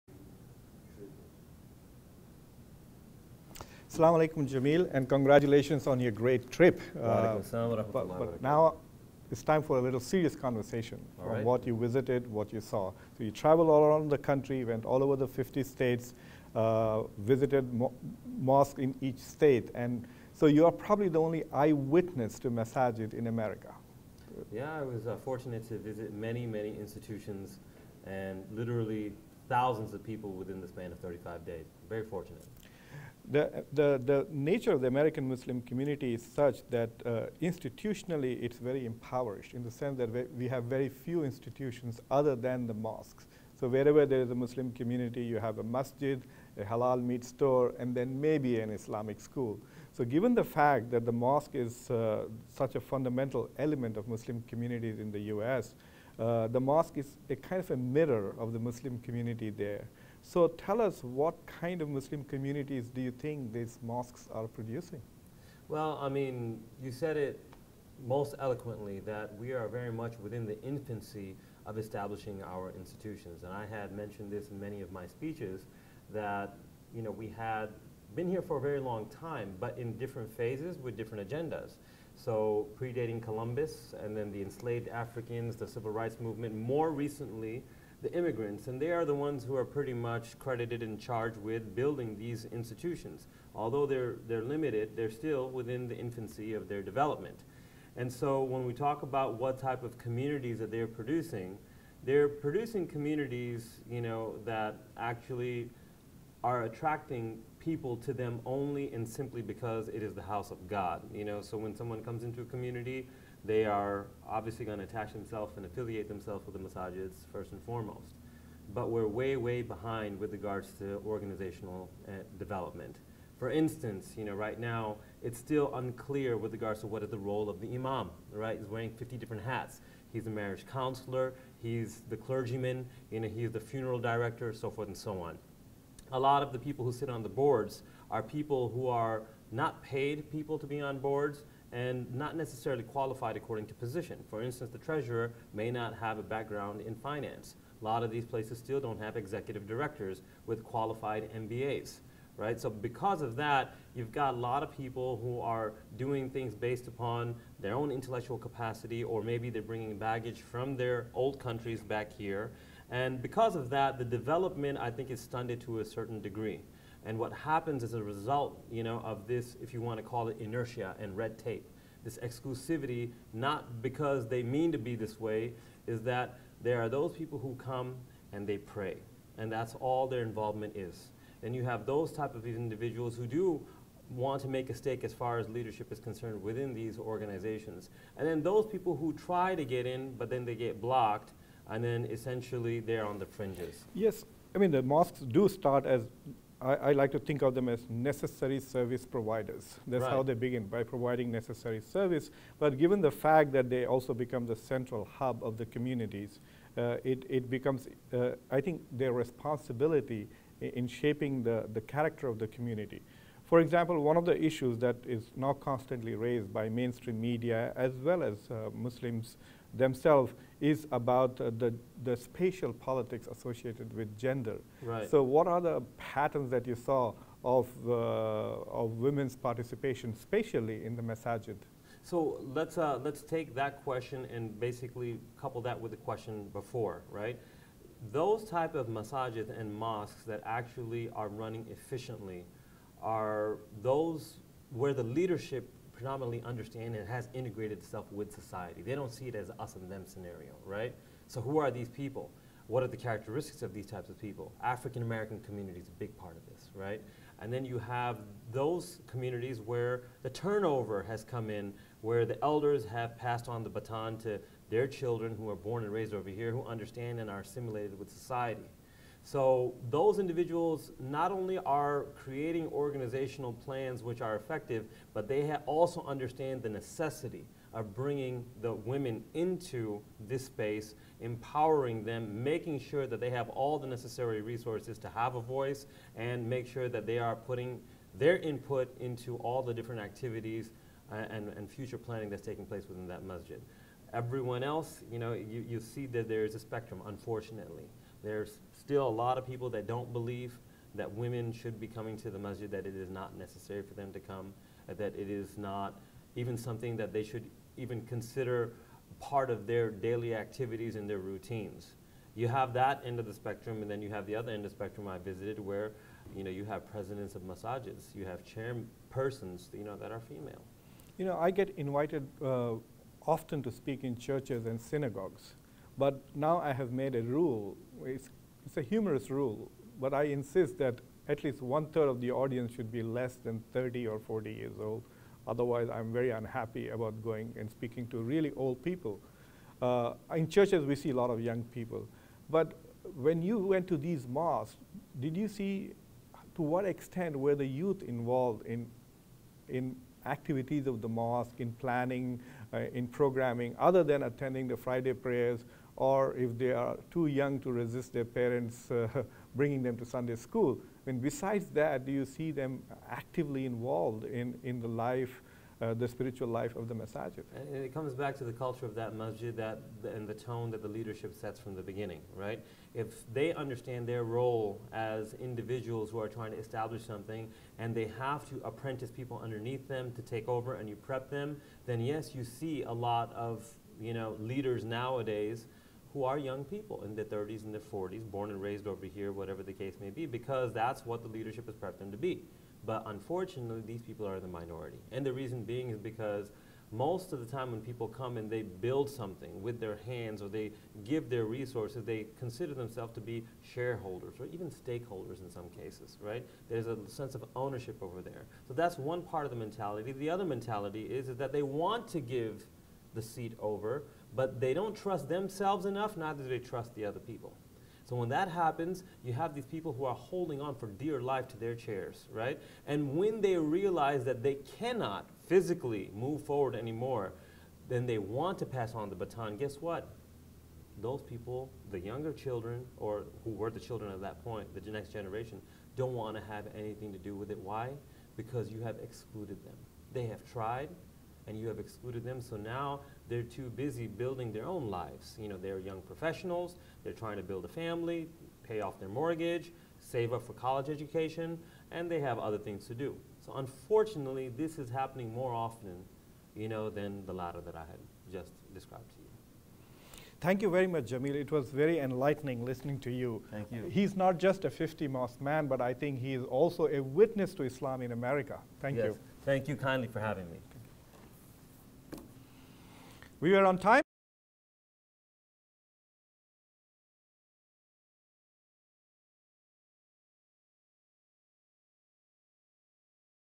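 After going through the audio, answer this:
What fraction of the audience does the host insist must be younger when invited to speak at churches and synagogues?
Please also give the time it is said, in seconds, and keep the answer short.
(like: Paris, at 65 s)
one third, at 331 s.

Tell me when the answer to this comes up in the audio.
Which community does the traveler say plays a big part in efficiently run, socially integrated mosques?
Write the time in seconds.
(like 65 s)
254 s.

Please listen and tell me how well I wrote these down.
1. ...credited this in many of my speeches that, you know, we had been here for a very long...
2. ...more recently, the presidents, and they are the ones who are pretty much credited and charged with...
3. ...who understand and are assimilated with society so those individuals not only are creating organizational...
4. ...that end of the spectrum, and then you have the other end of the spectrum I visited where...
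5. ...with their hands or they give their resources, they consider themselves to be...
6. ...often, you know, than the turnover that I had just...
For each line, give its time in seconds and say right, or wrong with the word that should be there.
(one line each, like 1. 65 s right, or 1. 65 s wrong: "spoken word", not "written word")
1. 73 s wrong: "mentioned", not "credited"
2. 86 s wrong: "immigrants", not "presidents"
3. 266 s right
4. 312 s right
5. 399 s right
6. 455 s wrong: "latter", not "turnover".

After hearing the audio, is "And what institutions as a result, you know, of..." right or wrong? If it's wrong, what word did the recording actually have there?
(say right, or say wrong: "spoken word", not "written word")
wrong: "happens", not "institutions".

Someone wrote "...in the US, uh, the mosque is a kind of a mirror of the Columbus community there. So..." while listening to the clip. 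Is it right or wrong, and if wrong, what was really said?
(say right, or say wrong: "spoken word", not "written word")
wrong: "Muslim", not "Columbus".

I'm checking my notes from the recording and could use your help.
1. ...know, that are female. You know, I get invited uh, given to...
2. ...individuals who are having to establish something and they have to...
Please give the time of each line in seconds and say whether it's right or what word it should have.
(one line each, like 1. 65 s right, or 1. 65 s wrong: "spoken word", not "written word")
1. 319 s wrong: "often", not "given"
2. 375 s wrong: "trying", not "having".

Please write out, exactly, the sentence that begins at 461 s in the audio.
It was very enlightening listening to you.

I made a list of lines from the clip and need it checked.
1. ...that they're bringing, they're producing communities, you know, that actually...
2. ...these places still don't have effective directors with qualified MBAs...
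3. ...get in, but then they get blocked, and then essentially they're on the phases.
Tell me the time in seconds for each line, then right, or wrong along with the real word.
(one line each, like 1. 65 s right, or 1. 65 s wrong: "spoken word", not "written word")
1. 100 s wrong: "producing", not "bringing"
2. 148 s wrong: "executive", not "effective"
3. 189 s wrong: "fringes", not "phases".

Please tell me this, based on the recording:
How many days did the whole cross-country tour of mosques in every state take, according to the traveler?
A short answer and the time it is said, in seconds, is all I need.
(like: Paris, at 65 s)
35, at 30 s.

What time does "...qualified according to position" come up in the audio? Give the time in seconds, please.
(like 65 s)
142 s.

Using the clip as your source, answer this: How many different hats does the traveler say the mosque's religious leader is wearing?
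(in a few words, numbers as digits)
50.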